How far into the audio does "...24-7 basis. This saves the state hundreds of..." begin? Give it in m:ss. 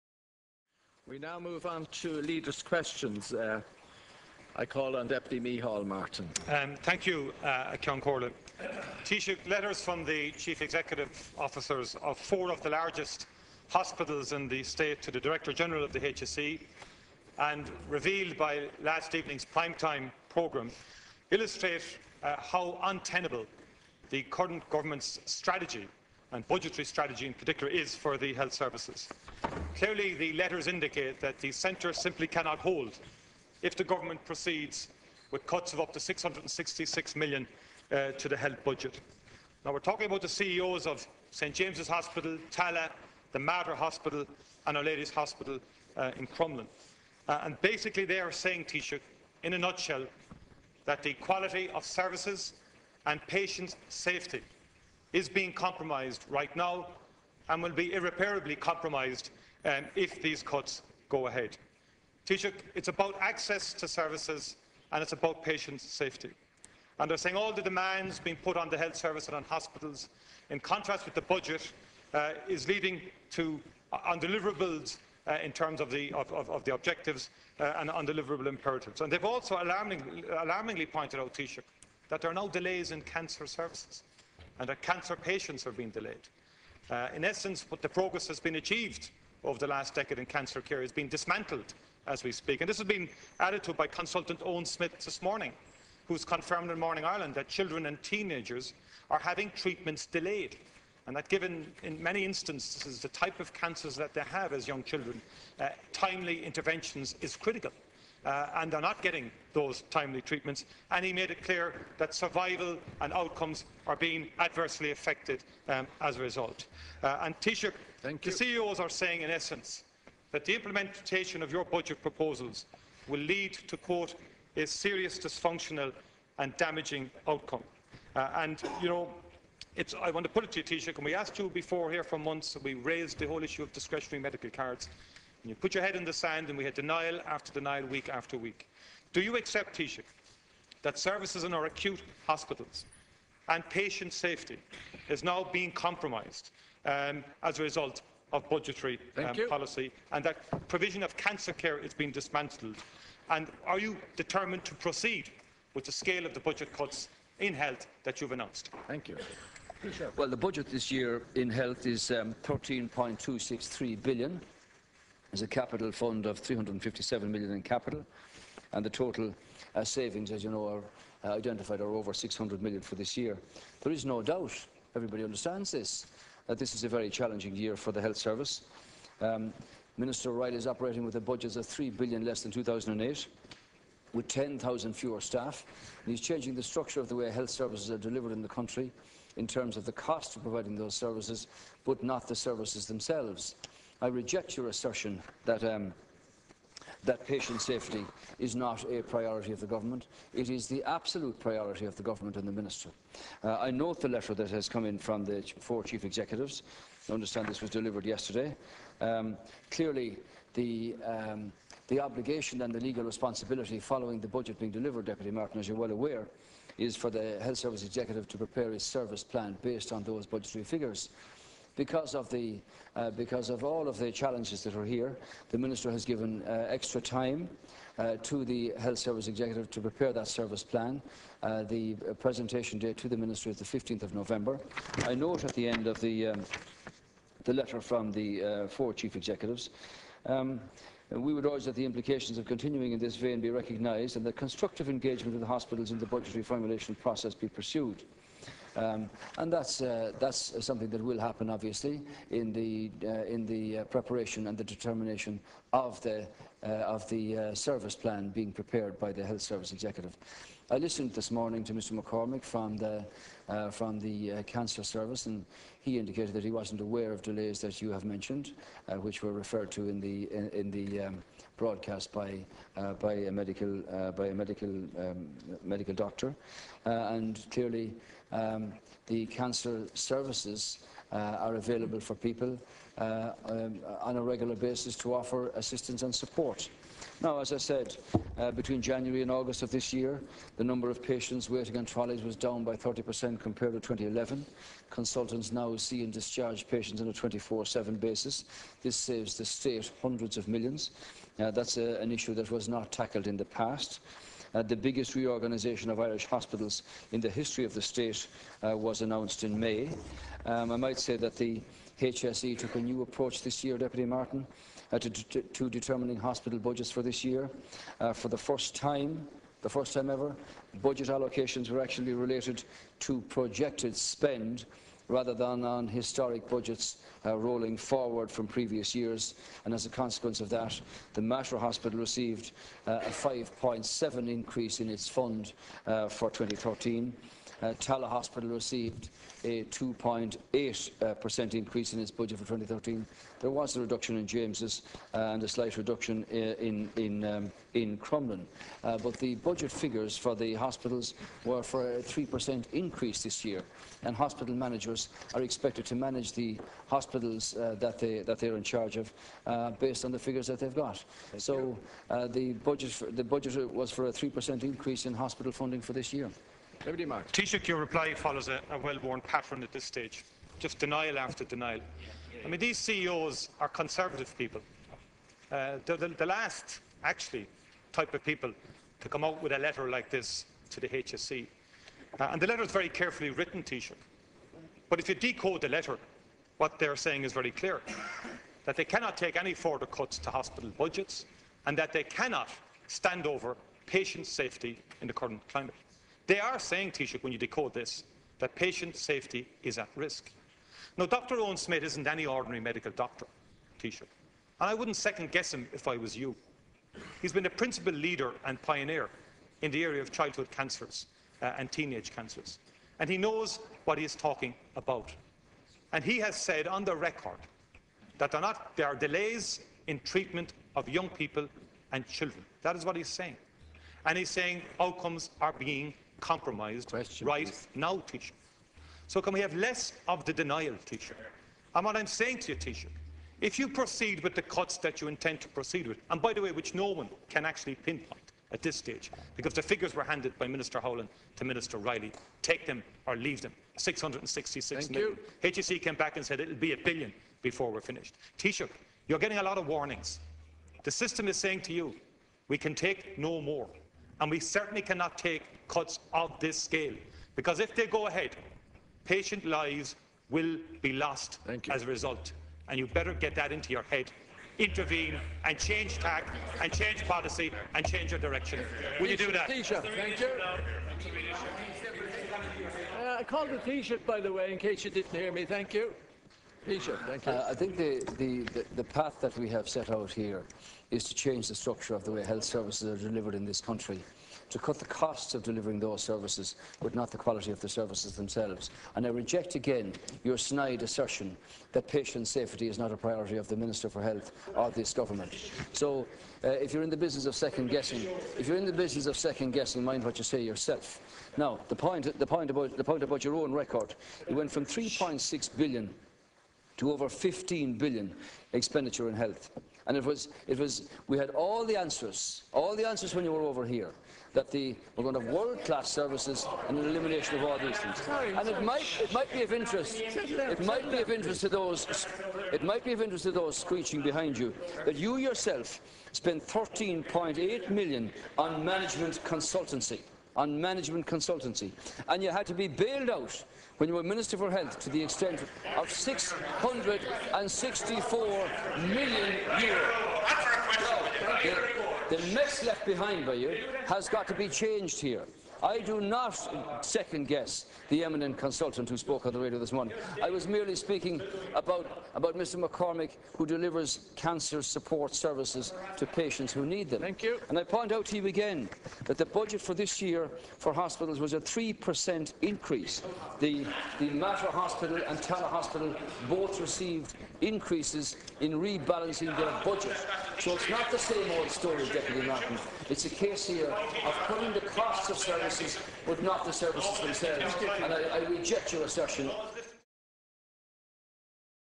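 4:57.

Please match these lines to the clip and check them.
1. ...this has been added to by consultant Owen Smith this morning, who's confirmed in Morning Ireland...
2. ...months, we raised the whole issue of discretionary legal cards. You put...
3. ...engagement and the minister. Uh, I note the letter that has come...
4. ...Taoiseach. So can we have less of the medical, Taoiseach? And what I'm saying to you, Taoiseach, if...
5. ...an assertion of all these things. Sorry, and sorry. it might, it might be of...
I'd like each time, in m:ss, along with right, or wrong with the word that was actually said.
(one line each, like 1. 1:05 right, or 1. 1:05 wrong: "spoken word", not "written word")
1. 1:32 right
2. 2:12 wrong: "medical", not "legal"
3. 3:22 wrong: "government", not "engagement"
4. 7:07 wrong: "denial", not "medical"
5. 8:36 wrong: "elimination", not "assertion".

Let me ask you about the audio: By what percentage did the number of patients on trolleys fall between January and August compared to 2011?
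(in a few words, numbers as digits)
30%.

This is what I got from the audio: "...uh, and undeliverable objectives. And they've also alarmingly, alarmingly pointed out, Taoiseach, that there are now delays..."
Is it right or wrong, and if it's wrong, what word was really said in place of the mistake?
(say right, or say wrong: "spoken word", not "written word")
wrong: "imperatives", not "objectives".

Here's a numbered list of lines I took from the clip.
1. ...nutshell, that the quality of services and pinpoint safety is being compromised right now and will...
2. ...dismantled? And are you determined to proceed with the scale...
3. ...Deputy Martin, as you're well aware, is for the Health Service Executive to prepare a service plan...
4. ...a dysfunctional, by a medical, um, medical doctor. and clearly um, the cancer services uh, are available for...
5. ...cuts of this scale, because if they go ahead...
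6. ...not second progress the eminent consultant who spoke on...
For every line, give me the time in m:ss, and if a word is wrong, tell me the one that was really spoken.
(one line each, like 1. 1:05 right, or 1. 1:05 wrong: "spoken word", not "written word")
1. 0:49 wrong: "patient", not "pinpoint"
2. 2:32 right
3. 3:35 right
4. 4:33 wrong: "medical", not "dysfunctional"
5. 7:35 right
6. 9:06 wrong: "guess", not "progress".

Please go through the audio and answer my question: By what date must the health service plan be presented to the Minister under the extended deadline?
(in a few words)
15th of November.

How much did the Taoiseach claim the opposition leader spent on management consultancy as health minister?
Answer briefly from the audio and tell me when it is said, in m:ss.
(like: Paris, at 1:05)
13.8 million, at 8:46.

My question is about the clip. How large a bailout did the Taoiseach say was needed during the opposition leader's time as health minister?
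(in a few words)
664 million euro.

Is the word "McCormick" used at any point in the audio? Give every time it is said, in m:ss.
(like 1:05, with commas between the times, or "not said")
4:22, 9:12.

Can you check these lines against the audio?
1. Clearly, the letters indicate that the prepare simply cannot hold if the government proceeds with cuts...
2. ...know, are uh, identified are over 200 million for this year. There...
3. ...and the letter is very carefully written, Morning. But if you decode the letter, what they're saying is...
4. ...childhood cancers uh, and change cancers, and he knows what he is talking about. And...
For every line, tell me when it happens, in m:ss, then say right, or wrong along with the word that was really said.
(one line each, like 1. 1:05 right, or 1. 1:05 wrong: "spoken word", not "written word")
1. 0:29 wrong: "centre", not "prepare"
2. 2:50 wrong: "600", not "200"
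3. 6:22 wrong: "Taoiseach", not "Morning"
4. 6:50 wrong: "teenage", not "change".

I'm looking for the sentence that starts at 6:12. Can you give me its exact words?
I mean, these CEOs are conservative people.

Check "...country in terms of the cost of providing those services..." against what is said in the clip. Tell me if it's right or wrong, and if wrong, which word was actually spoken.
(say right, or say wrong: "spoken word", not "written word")
right.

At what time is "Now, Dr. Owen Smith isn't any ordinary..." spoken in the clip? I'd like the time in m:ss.
6:40.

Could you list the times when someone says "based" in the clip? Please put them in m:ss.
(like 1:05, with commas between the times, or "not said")
3:39, 5:59.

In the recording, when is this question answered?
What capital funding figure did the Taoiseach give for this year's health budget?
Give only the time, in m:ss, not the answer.
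2:46.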